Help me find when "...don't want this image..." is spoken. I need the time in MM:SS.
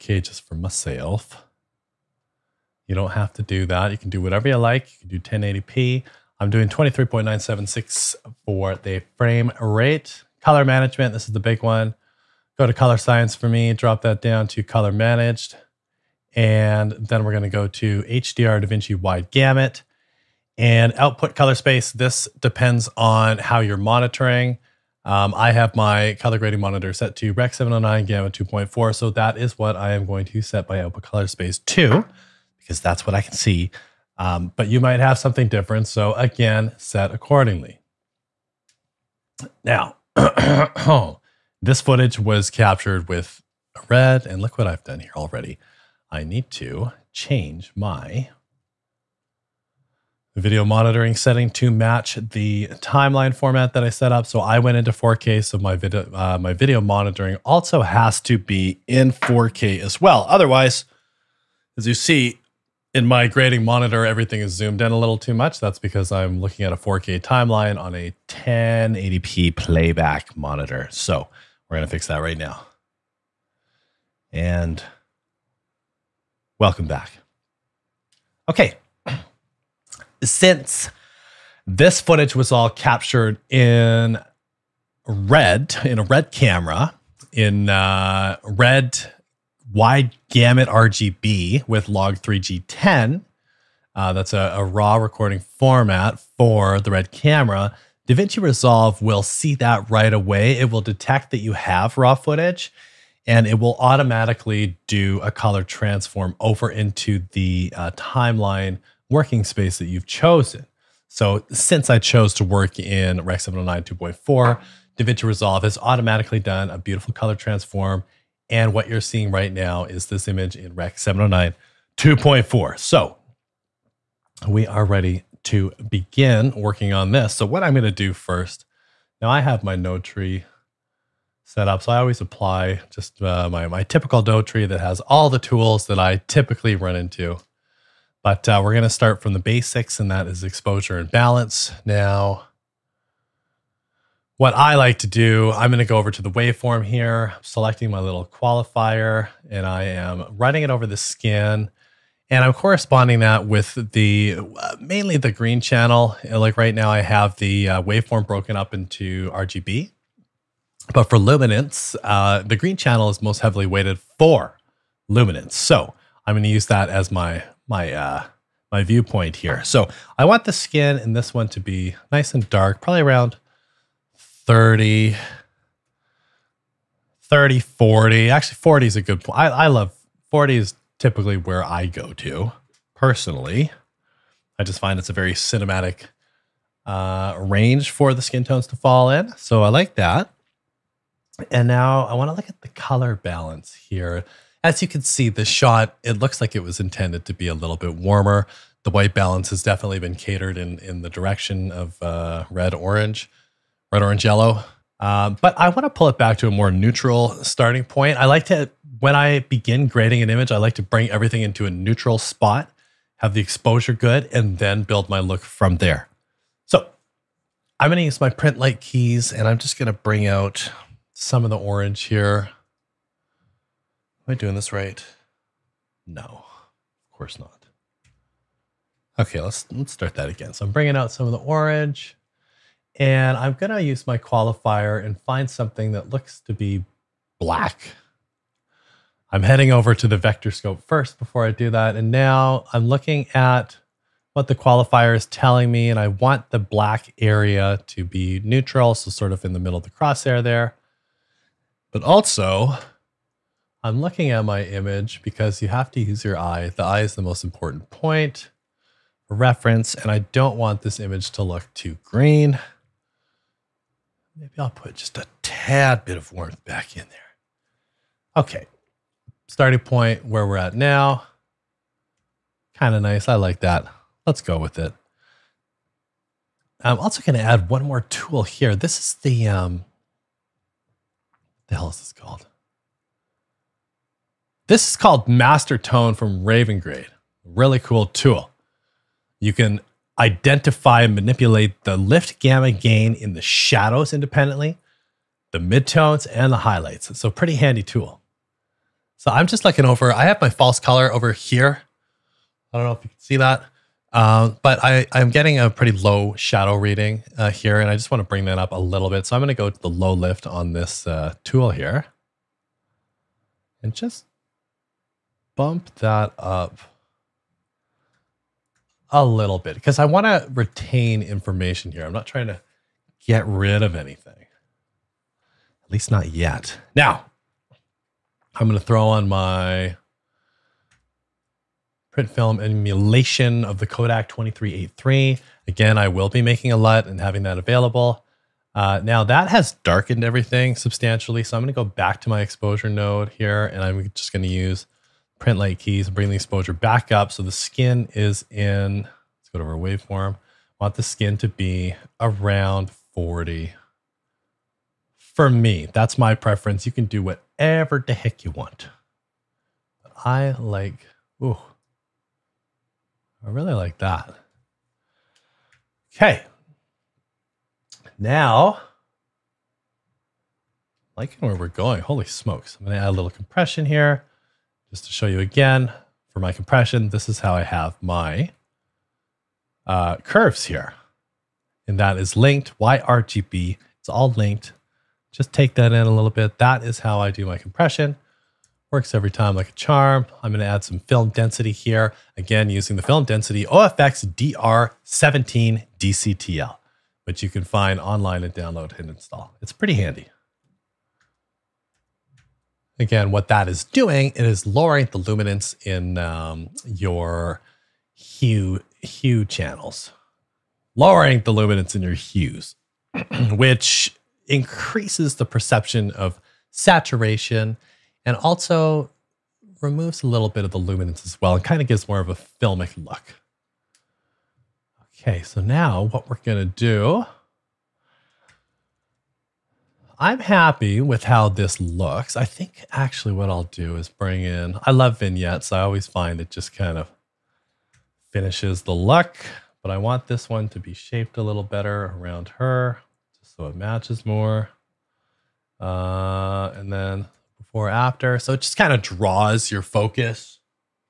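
04:20.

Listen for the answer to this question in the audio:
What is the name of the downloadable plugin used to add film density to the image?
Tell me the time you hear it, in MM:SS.
06:34.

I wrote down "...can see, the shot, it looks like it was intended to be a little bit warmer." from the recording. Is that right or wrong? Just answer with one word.
right.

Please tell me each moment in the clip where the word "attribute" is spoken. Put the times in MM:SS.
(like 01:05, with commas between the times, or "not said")
not said.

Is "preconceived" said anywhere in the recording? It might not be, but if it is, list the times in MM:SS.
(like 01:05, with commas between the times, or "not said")
not said.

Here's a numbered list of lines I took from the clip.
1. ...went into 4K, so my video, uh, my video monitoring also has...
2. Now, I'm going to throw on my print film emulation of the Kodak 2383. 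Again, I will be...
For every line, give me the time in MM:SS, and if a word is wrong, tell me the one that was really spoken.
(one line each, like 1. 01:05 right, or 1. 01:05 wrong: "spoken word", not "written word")
1. 00:54 right
2. 05:26 right.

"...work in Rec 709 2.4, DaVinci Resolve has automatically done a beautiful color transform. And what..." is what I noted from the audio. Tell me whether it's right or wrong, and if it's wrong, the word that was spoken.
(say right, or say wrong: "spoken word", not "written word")
right.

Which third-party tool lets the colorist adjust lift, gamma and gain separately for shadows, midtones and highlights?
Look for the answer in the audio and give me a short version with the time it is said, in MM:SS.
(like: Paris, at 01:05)
Master Tone, at 04:45.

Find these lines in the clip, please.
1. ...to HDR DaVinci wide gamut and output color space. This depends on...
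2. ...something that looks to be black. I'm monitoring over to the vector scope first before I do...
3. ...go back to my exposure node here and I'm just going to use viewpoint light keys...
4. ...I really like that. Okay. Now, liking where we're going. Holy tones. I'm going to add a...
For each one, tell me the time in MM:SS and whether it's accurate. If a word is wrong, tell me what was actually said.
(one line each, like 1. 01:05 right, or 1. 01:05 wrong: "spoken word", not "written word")
1. 00:17 right
2. 03:55 wrong: "heading", not "monitoring"
3. 05:41 wrong: "print", not "viewpoint"
4. 06:03 wrong: "smokes", not "tones".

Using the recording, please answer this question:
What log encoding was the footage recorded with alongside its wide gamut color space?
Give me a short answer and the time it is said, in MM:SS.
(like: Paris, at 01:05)
Log3G10, at 01:31.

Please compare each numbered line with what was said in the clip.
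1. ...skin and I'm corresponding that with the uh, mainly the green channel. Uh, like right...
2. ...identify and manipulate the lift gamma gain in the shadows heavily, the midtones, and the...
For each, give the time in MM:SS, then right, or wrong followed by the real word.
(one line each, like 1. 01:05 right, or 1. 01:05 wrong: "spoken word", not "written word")
1. 02:30 right
2. 04:50 wrong: "independently", not "heavily".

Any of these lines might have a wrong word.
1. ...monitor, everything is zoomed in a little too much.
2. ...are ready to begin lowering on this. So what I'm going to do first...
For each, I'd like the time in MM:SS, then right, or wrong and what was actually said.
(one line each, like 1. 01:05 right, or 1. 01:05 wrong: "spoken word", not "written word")
1. 01:03 right
2. 02:04 wrong: "working", not "lowering".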